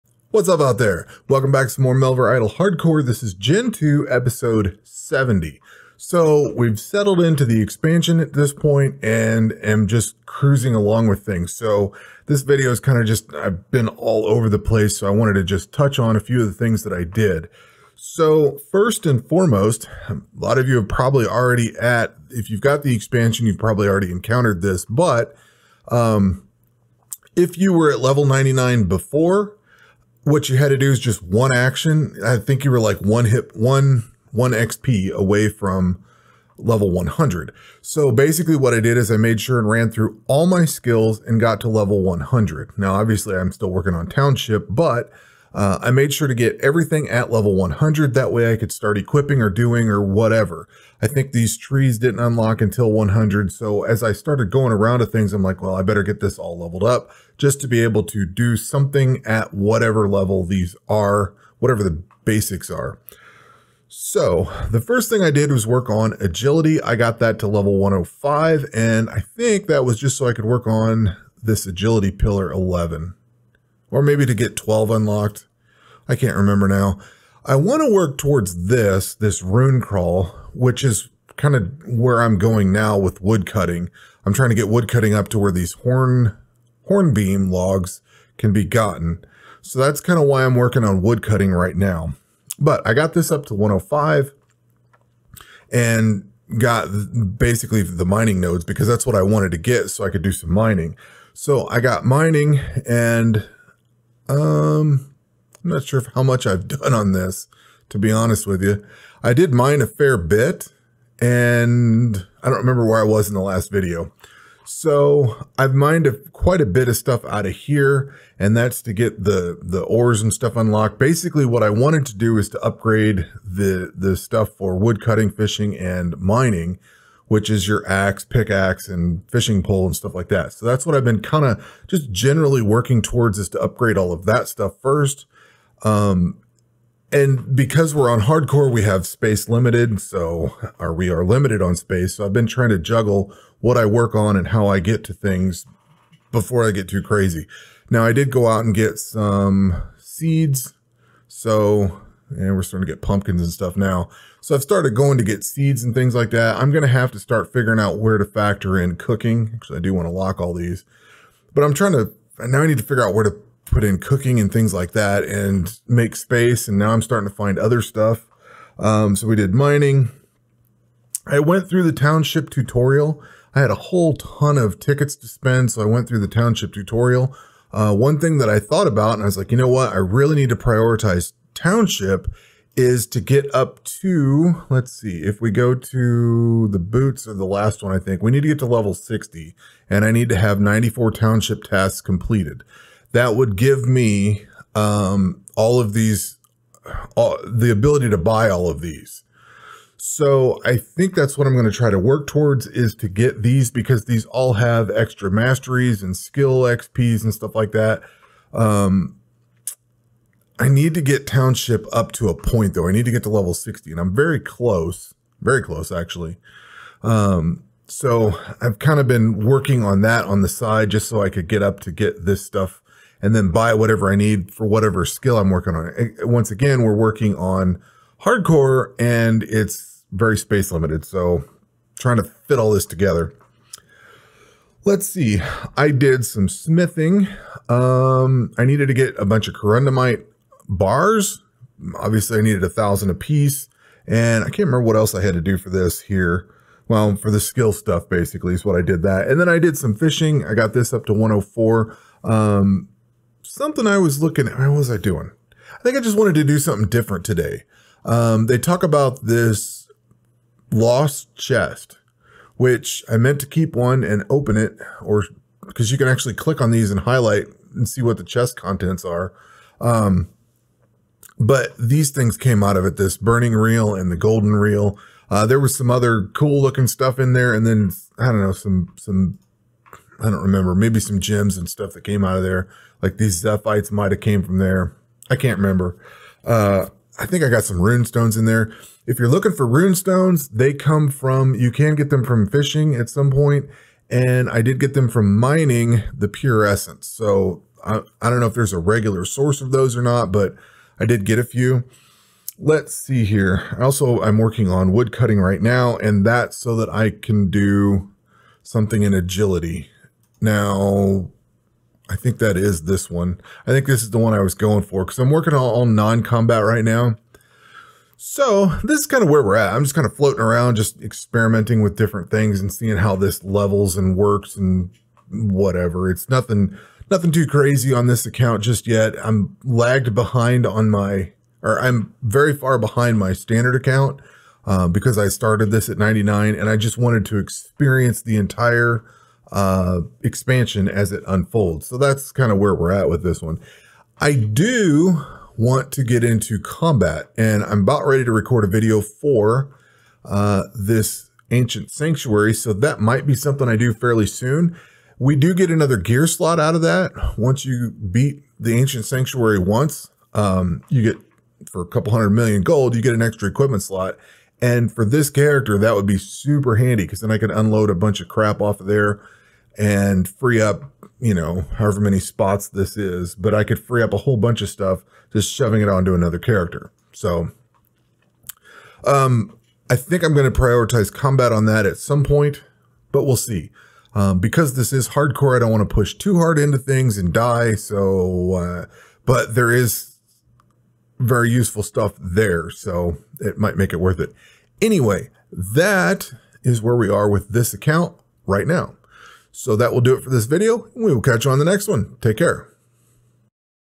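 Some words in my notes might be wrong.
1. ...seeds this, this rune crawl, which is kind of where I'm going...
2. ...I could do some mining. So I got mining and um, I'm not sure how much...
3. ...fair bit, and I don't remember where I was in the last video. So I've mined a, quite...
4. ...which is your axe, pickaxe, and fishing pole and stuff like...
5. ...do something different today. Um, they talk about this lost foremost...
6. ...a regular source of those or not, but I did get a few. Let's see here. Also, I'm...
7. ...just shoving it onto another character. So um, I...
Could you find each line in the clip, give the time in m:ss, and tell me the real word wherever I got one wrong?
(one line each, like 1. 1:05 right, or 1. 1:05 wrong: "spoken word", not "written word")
1. 1:18 wrong: "towards", not "seeds"
2. 1:40 right
3. 1:49 right
4. 2:07 right
5. 4:16 wrong: "chest", not "foremost"
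6. 4:58 right
7. 6:15 right.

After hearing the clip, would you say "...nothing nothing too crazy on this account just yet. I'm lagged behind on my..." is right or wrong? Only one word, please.
right.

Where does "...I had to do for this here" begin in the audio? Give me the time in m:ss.
4:05.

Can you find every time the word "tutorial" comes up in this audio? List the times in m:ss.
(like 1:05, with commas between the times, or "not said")
2:52, 2:56.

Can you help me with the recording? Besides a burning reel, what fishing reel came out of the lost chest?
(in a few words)
Golden reel.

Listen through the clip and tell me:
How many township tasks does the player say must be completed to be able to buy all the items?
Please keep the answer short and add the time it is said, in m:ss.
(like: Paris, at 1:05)
94, at 3:10.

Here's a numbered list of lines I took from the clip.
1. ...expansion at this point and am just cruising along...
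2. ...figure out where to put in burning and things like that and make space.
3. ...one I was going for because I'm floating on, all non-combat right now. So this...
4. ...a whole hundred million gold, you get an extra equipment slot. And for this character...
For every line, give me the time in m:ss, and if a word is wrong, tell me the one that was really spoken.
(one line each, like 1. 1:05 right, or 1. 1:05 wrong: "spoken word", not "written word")
1. 0:07 right
2. 2:42 wrong: "cooking", not "burning"
3. 5:14 wrong: "working", not "floating"
4. 6:01 wrong: "couple", not "whole".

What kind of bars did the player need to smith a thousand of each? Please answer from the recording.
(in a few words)
Corundumite bars.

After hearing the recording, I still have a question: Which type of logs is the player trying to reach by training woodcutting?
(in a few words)
Hornbeam logs.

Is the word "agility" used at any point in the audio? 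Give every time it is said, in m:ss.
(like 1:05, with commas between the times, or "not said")
1:06, 1:11, 5:09.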